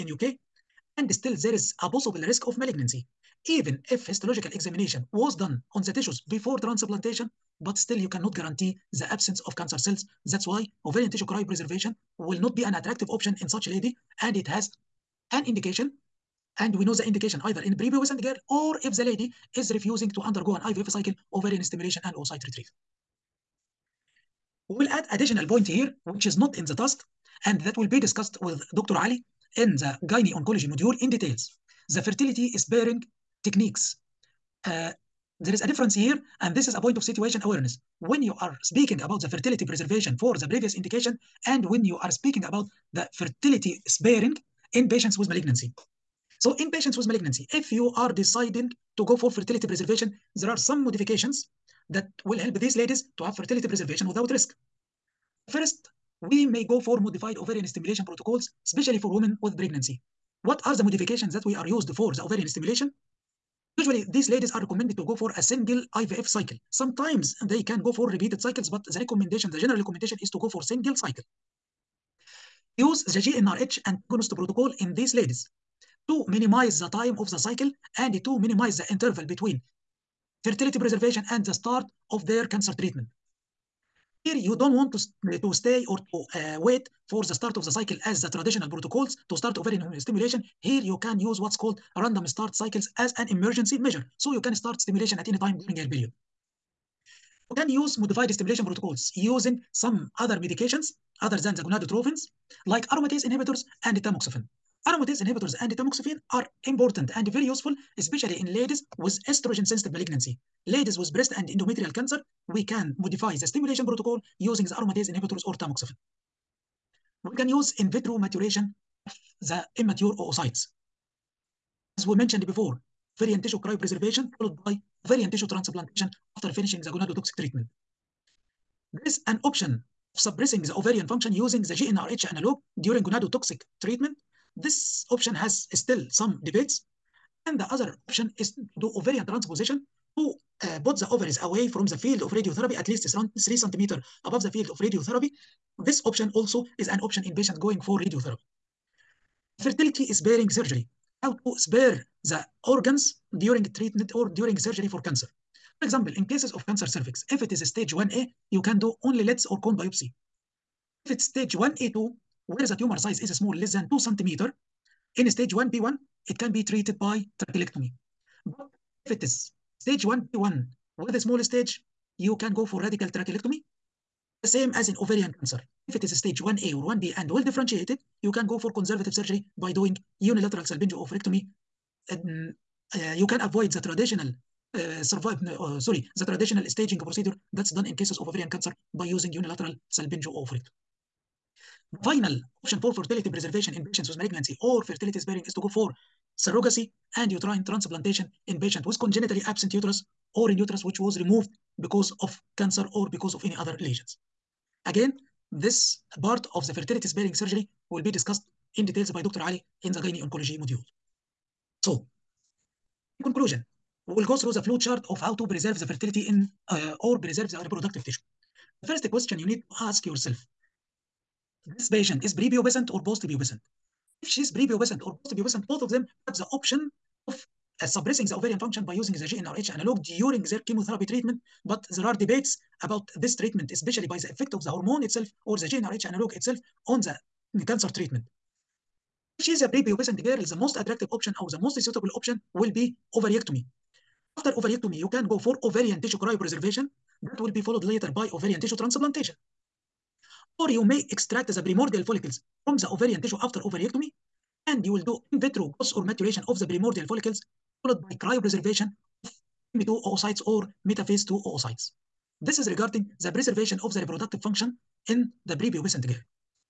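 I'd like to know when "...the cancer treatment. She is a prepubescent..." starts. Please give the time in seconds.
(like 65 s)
237 s.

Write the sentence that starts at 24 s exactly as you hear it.
We will add additional point here, which is not in the task, and that will be discussed with Dr.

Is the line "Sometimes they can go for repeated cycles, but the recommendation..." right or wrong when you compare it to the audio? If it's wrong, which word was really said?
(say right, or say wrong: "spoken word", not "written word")
right.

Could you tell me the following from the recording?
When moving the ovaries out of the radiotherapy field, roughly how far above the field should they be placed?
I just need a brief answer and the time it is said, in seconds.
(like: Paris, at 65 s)
3 centimeters, at 143 s.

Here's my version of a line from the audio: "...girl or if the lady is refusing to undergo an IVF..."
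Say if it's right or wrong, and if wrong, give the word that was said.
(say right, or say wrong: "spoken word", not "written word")
right.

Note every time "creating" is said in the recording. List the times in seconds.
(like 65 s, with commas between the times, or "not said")
not said.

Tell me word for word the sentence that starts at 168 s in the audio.
But if it is stage 1B1 with a small stage, you can go for radical trachelectomy, the same as in ovarian cancer.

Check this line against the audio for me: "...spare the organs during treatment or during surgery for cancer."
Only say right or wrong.
right.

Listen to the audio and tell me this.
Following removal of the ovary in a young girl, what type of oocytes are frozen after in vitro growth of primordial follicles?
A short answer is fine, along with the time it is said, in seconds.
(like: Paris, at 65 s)
M2 oocytes, at 259 s.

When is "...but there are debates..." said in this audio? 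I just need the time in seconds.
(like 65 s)
231 s.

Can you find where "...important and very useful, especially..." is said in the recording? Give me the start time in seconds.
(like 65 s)
106 s.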